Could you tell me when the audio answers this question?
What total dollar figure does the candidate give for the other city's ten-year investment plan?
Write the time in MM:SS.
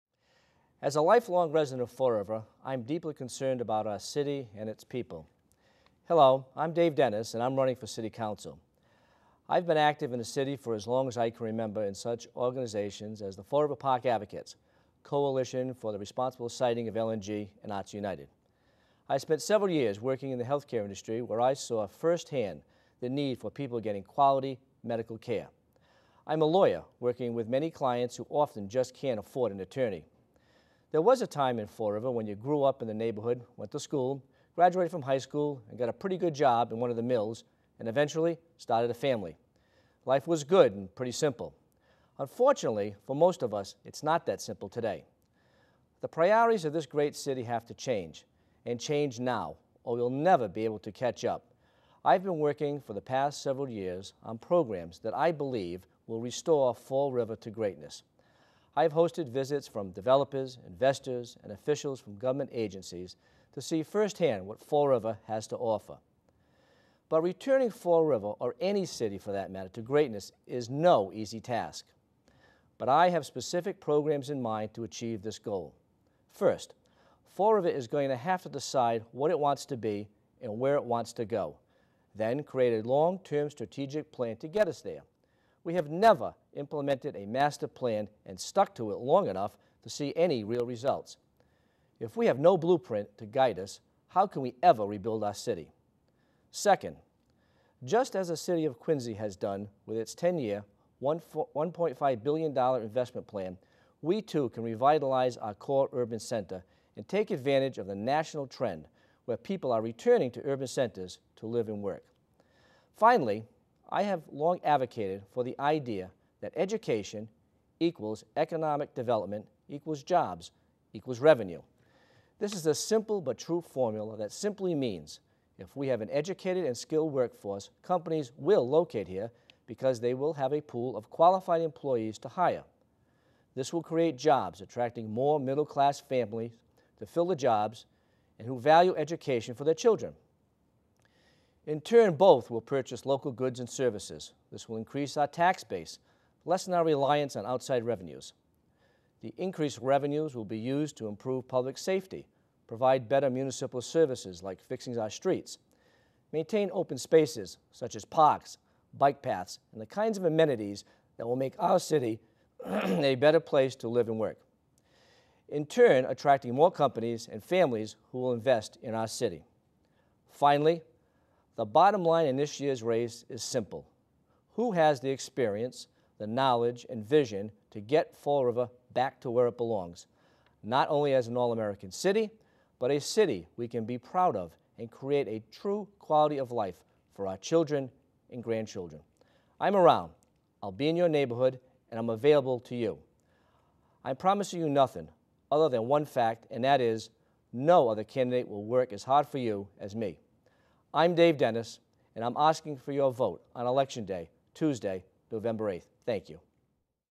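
01:41.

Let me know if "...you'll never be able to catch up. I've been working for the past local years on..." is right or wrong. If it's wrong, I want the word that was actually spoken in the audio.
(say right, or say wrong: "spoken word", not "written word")
wrong: "several", not "local".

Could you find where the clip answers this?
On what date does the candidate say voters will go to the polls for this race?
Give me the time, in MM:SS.
03:24.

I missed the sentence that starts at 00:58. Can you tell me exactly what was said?
I have hosted visits from developers, investors, and officials from government agencies to see firsthand what Fall River has to offer.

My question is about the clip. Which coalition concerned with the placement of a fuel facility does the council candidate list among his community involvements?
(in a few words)
Coalition for the Responsible Siting of LNG.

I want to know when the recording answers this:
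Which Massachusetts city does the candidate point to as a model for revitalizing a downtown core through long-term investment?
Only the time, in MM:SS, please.
01:38.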